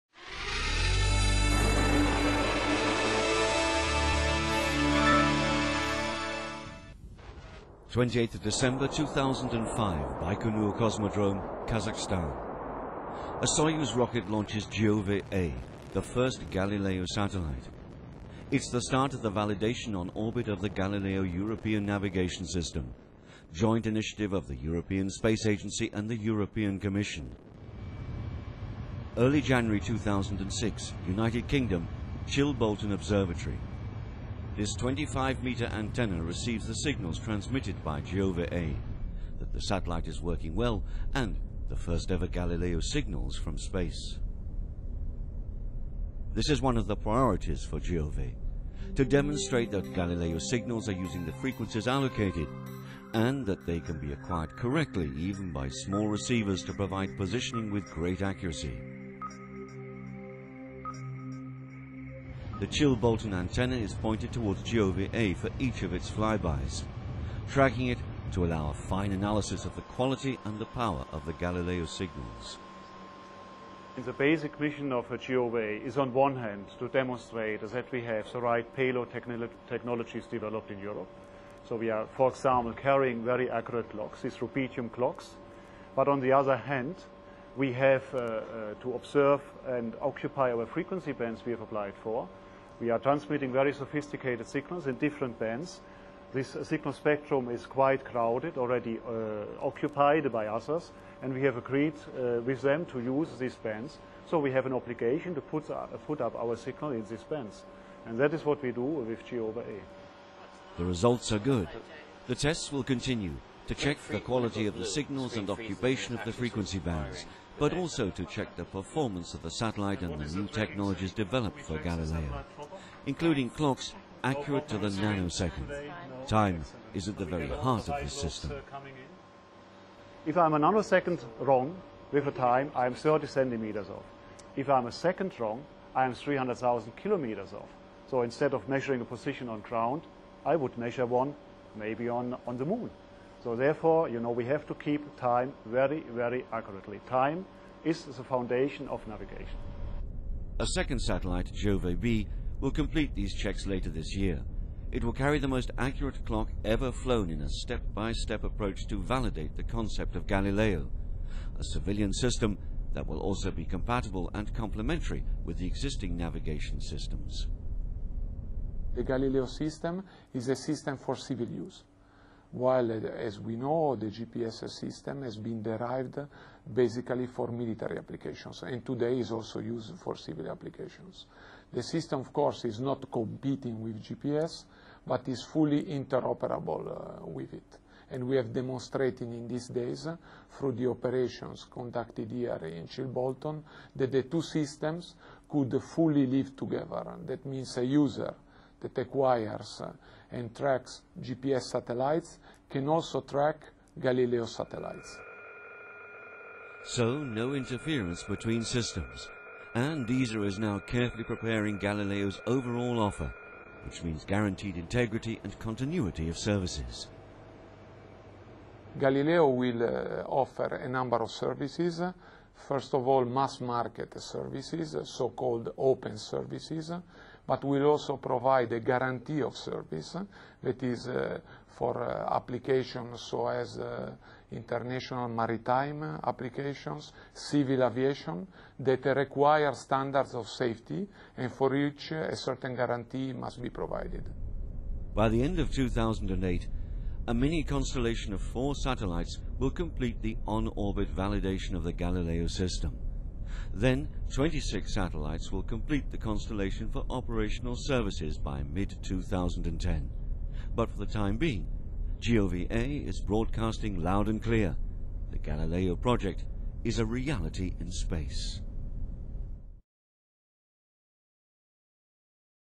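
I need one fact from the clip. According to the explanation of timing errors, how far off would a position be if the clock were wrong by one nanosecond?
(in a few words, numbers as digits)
30 centimeters.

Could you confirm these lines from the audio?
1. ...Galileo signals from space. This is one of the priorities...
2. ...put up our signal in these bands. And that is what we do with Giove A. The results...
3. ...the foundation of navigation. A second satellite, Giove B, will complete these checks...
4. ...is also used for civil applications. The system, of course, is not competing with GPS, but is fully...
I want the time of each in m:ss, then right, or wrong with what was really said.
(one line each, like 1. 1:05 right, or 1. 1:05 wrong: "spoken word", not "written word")
1. 0:42 right
2. 1:46 right
3. 2:28 right
4. 2:59 right.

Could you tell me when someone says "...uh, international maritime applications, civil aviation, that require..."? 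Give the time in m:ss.
3:53.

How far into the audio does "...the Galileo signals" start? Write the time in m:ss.
1:11.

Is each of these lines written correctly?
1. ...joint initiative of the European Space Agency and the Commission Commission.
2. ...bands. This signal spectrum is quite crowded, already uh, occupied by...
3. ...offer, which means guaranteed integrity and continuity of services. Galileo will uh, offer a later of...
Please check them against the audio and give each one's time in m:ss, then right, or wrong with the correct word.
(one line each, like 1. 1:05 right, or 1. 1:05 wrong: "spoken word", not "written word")
1. 0:23 wrong: "European", not "Commission"
2. 1:35 right
3. 3:32 wrong: "number", not "later".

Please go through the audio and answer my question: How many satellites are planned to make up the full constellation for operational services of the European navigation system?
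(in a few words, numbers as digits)
26.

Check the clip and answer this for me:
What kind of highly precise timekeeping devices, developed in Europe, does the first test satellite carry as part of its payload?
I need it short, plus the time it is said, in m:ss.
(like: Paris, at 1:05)
rubidium clocks, at 1:24.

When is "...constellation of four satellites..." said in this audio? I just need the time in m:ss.
4:07.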